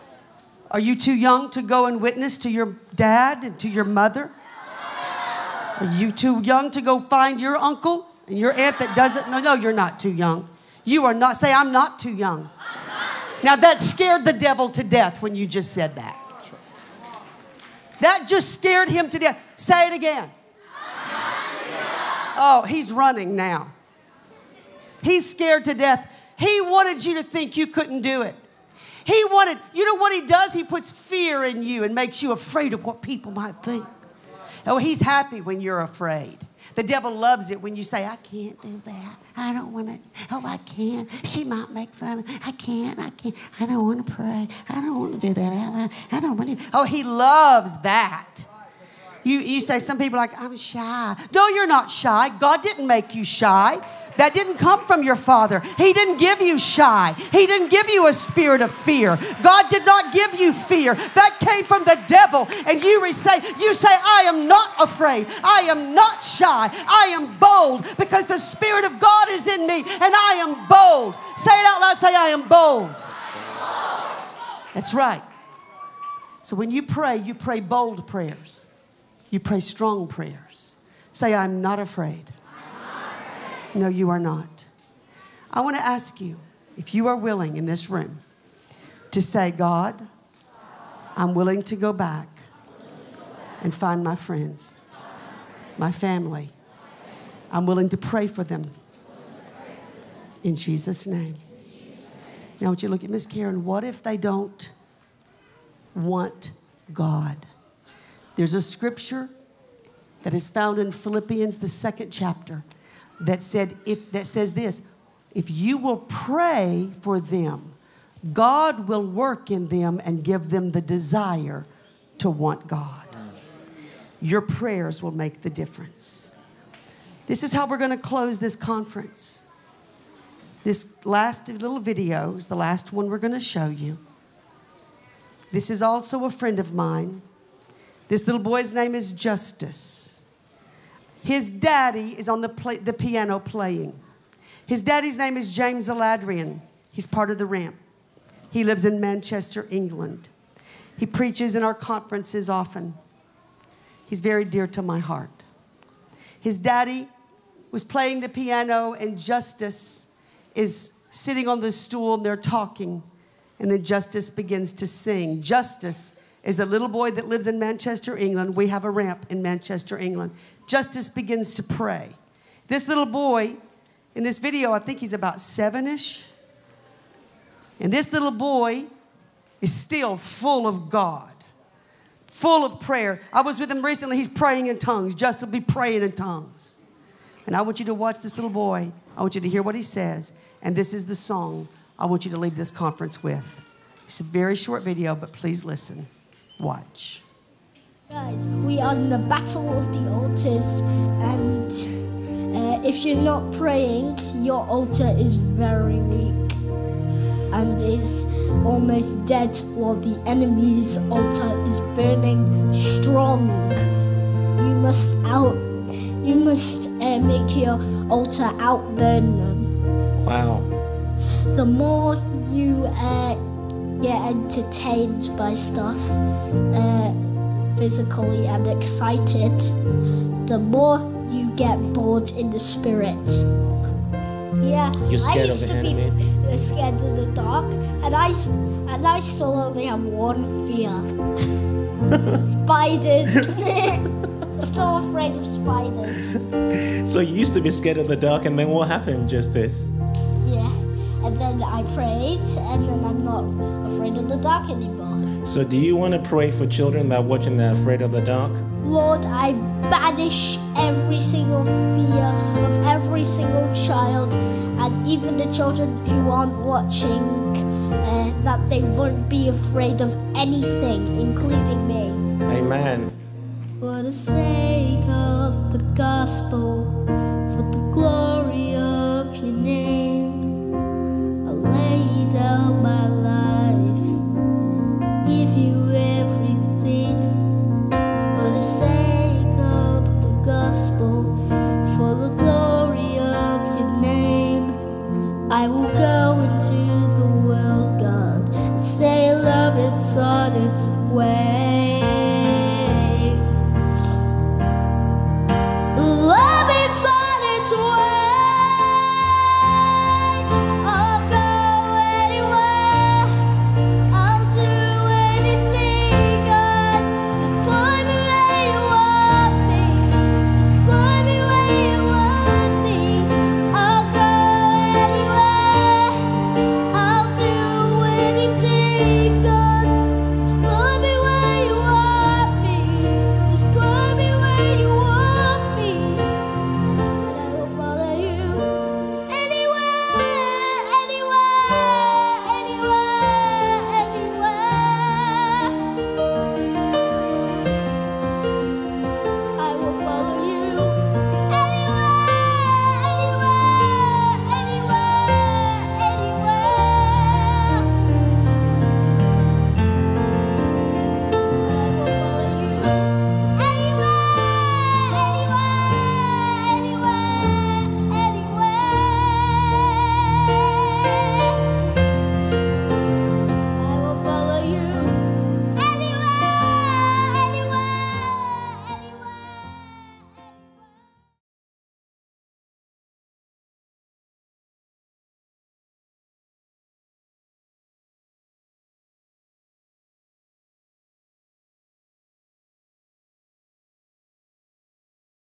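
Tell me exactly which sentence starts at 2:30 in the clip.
He preaches in our conferences often.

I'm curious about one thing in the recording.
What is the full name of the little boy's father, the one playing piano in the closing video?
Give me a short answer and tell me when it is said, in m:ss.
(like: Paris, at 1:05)
James Aladiran, at 2:25.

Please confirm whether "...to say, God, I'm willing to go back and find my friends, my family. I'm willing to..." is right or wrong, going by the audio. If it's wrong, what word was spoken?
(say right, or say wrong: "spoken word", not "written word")
right.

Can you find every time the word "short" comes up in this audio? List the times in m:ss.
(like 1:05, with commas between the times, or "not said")
3:14.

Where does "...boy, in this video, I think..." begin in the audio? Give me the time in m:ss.
2:53.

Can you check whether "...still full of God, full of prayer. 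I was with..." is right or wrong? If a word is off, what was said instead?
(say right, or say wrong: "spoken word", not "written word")
right.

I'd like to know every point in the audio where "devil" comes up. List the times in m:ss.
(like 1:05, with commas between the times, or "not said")
0:14, 0:36, 1:02.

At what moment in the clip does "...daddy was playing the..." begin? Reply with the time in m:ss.
2:36.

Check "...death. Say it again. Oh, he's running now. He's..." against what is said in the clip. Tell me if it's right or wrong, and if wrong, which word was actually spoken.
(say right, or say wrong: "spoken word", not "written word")
right.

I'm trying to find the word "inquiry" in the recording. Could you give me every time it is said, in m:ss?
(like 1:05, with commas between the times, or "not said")
not said.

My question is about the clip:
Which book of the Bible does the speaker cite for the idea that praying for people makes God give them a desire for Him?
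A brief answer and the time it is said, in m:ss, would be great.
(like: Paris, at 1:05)
Philippians, at 1:50.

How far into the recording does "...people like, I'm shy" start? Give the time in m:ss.
0:49.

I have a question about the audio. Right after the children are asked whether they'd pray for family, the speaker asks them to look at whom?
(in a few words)
Miss Karen.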